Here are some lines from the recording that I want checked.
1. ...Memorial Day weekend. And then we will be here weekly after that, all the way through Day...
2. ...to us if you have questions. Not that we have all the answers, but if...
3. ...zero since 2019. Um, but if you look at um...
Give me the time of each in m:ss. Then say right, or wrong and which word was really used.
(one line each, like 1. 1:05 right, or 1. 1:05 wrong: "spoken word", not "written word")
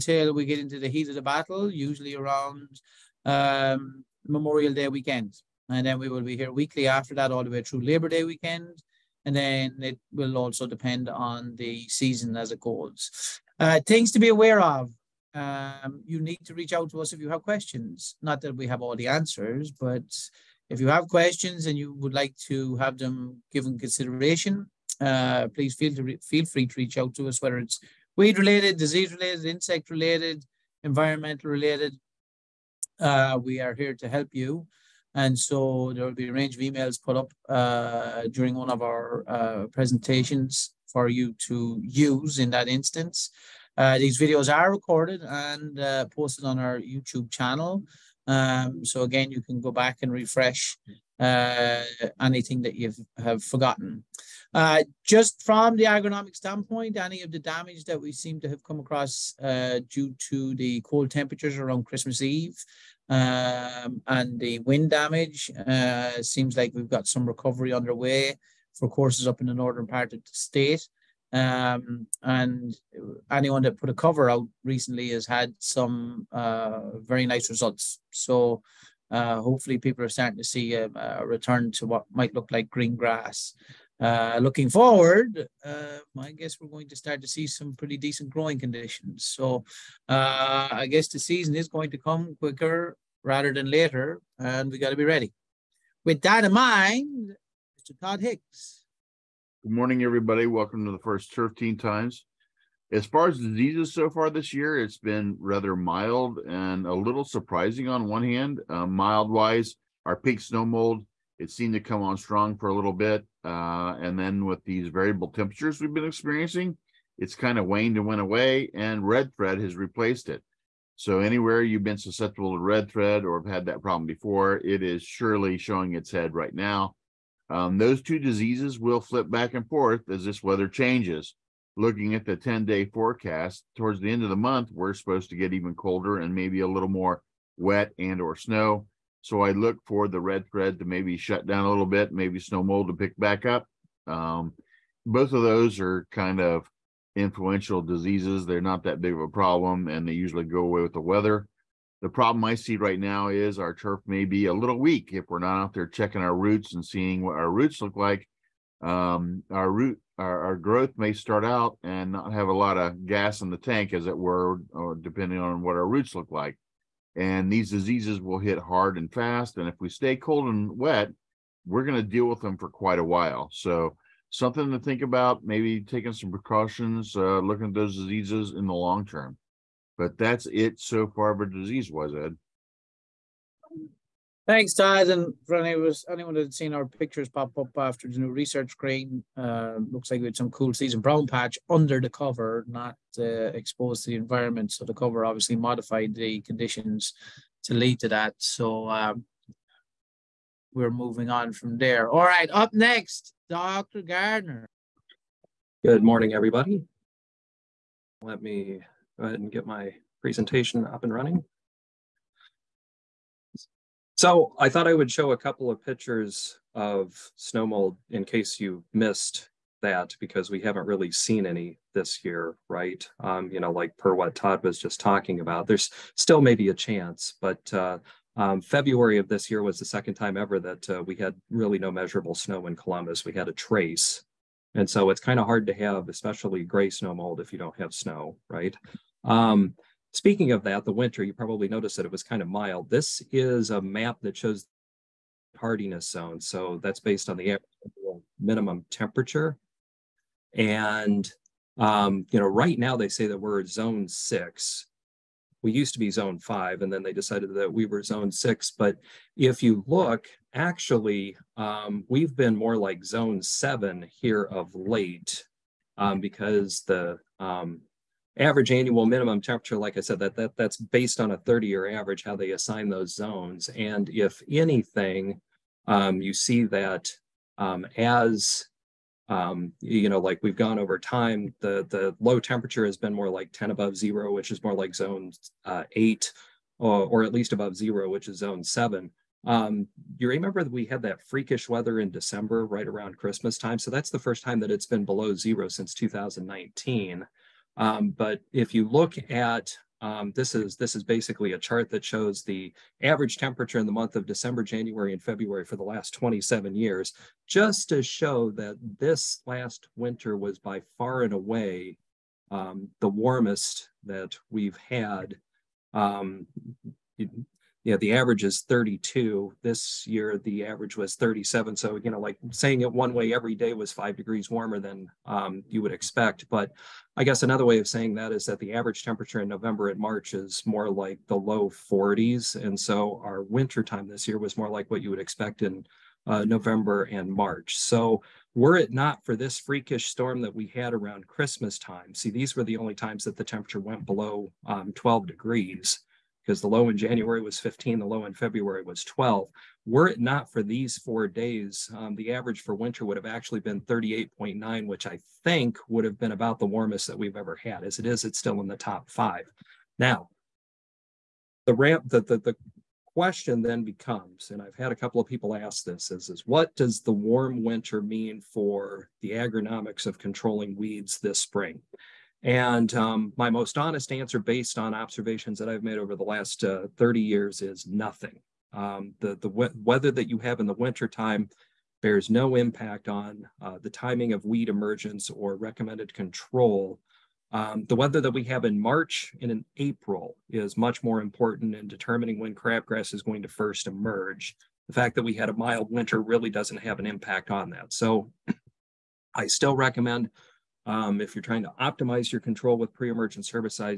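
1. 0:04 wrong: "Labor", not "Day"
2. 0:16 right
3. 4:55 right.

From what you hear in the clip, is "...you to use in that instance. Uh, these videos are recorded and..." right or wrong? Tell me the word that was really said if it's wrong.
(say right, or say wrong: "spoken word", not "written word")
right.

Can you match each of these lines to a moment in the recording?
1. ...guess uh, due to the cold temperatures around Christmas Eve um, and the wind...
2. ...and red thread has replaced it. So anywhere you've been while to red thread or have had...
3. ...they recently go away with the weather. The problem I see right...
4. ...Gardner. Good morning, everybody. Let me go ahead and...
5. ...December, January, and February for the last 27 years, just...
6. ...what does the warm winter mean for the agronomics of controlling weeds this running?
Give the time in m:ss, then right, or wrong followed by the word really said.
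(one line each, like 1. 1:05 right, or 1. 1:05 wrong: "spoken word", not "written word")
1. 0:58 wrong: "across", not "guess"
2. 1:58 wrong: "susceptible", not "while"
3. 2:30 wrong: "usually", not "recently"
4. 3:24 right
5. 5:04 right
6. 6:06 wrong: "spring", not "running".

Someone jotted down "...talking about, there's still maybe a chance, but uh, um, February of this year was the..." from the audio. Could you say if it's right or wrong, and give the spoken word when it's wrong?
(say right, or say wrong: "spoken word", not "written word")
right.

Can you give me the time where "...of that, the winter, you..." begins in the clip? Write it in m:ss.
4:00.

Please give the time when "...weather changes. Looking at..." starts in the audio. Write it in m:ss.
2:10.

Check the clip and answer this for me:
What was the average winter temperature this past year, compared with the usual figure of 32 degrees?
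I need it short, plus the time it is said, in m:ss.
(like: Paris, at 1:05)
37, at 5:21.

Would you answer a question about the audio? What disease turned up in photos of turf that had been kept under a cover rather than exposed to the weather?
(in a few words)
Cool season brown patch.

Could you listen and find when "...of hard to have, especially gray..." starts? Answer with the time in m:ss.
3:55.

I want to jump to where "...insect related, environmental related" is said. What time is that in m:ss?
0:29.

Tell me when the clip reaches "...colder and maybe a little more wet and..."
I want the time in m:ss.
2:15.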